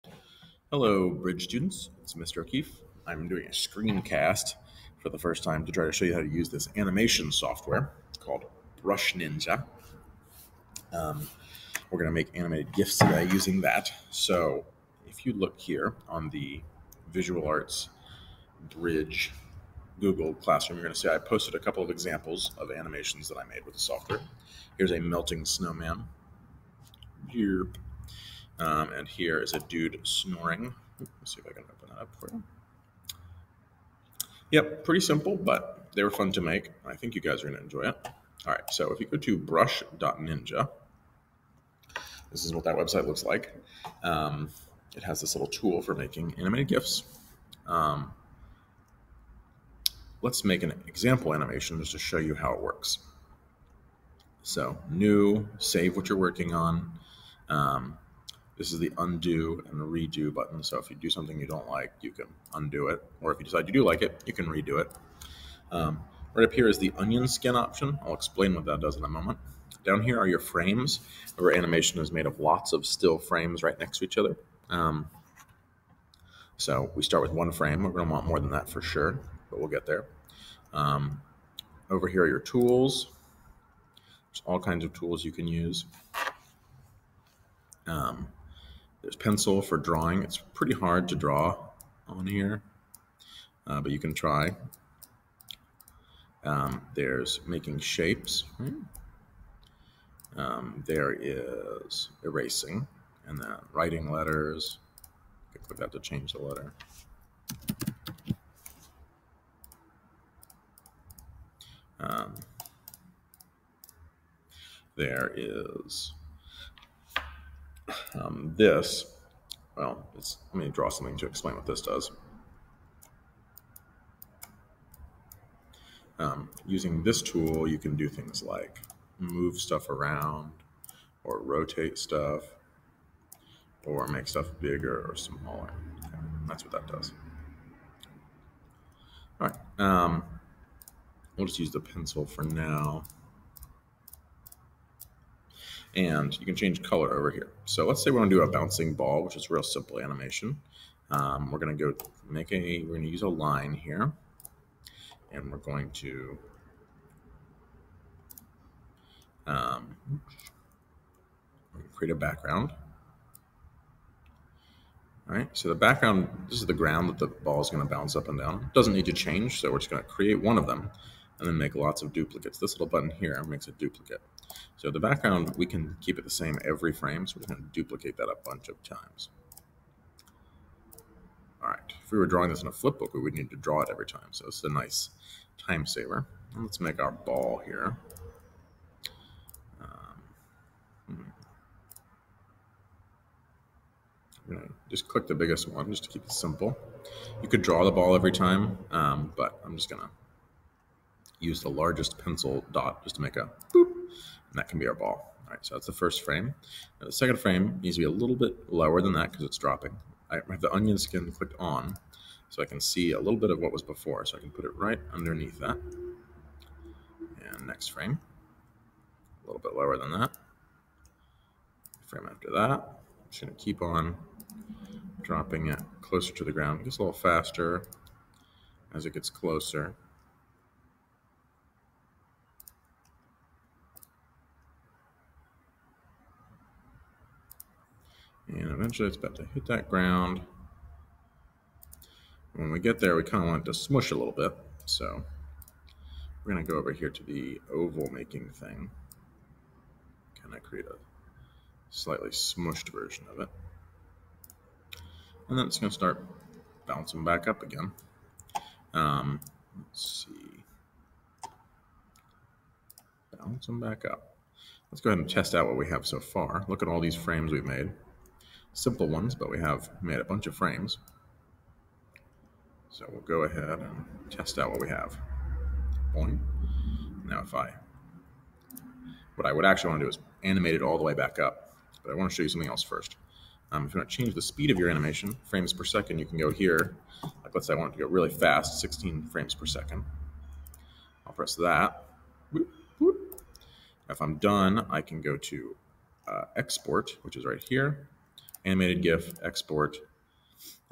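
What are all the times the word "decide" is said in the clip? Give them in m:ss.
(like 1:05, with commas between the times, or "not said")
1:03.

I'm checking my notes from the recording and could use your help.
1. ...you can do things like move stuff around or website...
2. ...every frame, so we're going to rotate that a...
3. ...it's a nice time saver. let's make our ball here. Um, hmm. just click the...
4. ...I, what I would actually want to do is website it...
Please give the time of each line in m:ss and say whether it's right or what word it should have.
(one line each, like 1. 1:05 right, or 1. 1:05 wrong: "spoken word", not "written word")
1. 2:07 wrong: "rotate", not "website"
2. 2:56 wrong: "duplicate", not "rotate"
3. 3:04 right
4. 4:37 wrong: "animate", not "website".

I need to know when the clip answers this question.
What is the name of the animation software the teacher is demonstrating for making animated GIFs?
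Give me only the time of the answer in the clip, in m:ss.
0:08.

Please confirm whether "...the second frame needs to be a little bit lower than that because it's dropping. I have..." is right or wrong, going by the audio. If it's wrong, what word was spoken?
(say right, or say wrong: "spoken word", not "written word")
right.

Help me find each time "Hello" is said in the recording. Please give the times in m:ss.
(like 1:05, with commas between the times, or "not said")
0:00.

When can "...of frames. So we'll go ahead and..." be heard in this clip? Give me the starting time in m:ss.
4:30.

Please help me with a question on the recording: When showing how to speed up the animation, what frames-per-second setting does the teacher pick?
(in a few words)
16.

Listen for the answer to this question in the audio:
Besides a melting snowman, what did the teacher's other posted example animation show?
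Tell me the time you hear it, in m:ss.
0:29.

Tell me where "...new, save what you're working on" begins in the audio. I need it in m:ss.
0:54.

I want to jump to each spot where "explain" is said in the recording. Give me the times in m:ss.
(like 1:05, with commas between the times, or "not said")
1:08, 2:01.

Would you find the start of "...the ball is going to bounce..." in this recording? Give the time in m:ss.
2:47.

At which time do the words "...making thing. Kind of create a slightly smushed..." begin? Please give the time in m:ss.
4:08.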